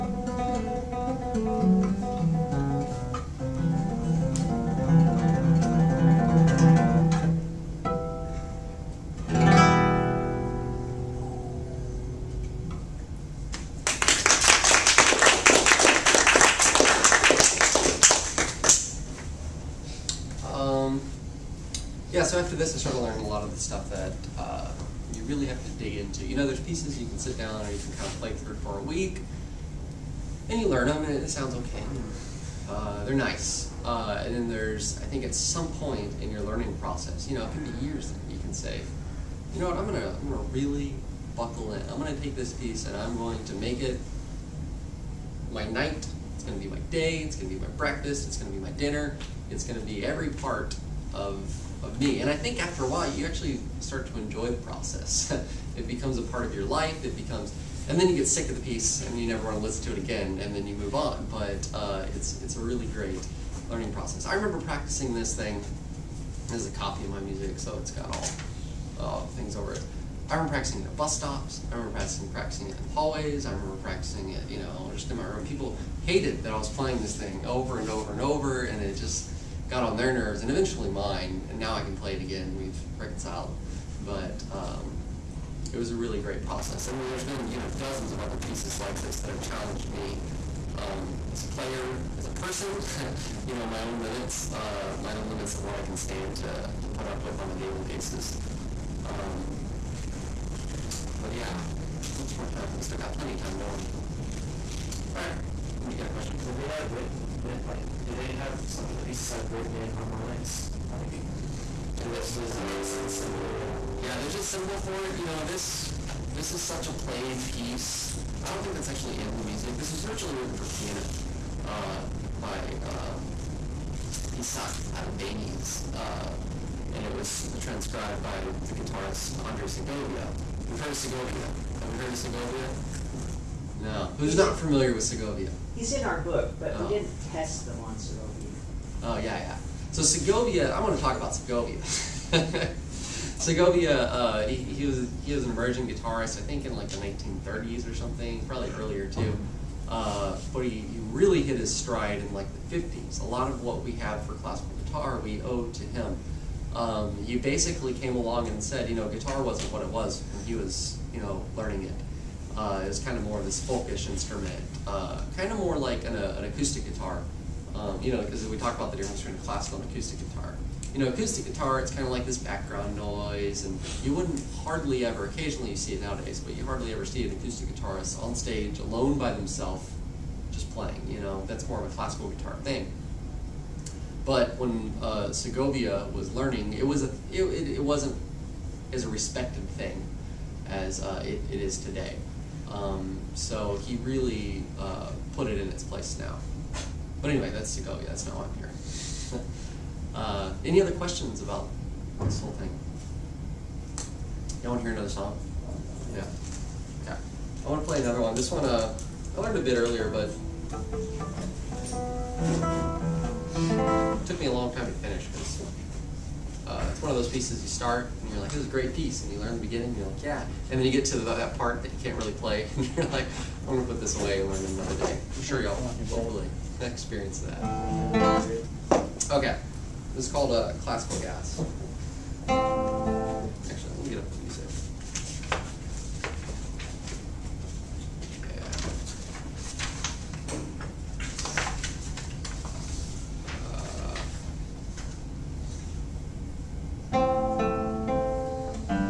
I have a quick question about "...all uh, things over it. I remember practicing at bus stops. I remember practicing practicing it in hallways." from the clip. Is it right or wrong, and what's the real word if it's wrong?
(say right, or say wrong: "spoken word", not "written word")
right.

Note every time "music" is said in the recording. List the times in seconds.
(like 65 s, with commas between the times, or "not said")
67 s, 119 s.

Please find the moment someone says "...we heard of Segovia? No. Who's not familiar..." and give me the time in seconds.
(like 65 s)
131 s.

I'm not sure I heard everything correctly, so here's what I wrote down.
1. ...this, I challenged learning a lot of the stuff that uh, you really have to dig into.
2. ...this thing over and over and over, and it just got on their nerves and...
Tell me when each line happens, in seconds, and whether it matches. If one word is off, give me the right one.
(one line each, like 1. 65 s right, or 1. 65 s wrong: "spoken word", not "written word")
1. 22 s wrong: "started", not "challenged"
2. 77 s right.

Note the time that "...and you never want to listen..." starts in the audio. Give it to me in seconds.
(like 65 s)
59 s.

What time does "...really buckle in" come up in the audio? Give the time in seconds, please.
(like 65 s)
40 s.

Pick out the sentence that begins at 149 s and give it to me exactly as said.
Uh, but he, he, really hit his stride in like the 50s.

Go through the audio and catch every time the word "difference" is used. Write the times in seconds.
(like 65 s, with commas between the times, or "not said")
168 s.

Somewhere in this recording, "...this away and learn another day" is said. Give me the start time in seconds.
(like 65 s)
223 s.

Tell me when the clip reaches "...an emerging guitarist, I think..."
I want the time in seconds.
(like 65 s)
145 s.